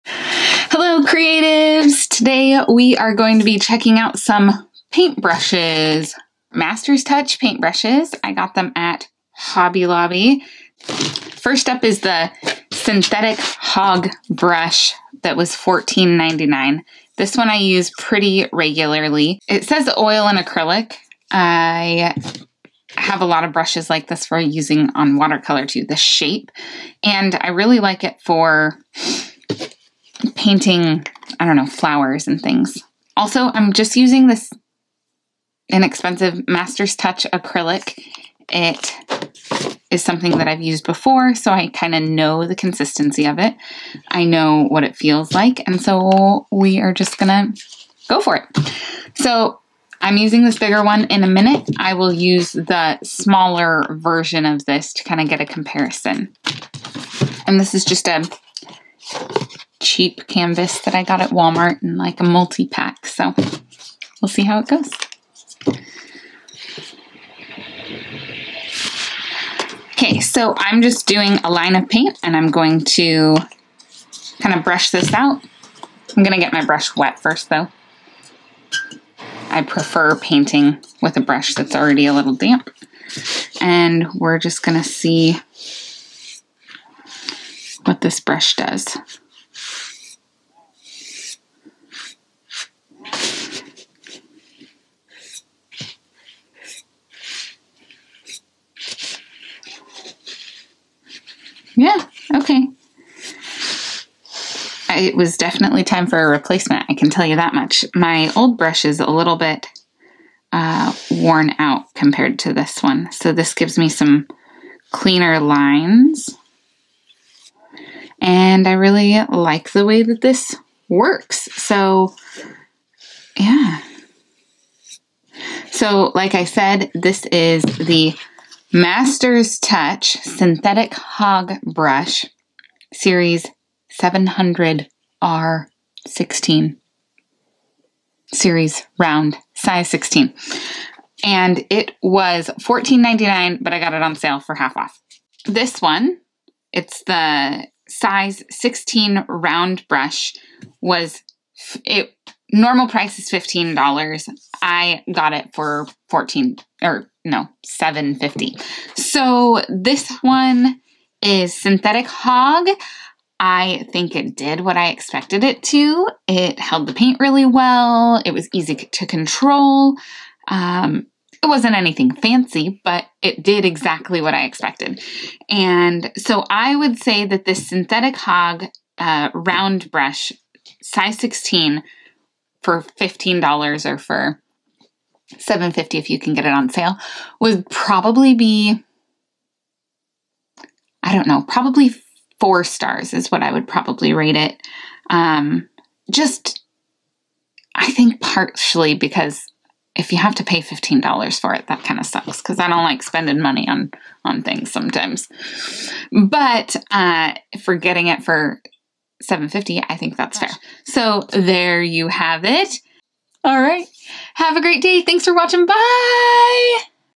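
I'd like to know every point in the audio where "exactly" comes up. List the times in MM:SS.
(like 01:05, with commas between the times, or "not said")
02:53.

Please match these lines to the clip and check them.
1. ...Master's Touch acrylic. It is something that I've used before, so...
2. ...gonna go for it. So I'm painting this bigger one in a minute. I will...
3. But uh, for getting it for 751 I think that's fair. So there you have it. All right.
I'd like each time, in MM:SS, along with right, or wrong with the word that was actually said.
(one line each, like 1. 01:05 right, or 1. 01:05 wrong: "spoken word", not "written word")
1. 00:36 right
2. 00:47 wrong: "using", not "painting"
3. 03:26 wrong: "750", not "751".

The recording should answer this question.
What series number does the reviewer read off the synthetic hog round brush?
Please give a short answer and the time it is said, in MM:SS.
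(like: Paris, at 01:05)
700R16, at 02:14.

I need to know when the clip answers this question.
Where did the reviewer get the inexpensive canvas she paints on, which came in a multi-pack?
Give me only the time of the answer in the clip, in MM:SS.
01:01.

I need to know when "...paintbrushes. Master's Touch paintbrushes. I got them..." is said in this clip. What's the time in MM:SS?
00:04.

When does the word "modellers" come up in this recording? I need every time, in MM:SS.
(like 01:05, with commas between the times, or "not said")
not said.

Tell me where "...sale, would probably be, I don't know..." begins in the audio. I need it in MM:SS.
03:06.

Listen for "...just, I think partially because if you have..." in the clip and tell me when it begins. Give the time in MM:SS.
03:16.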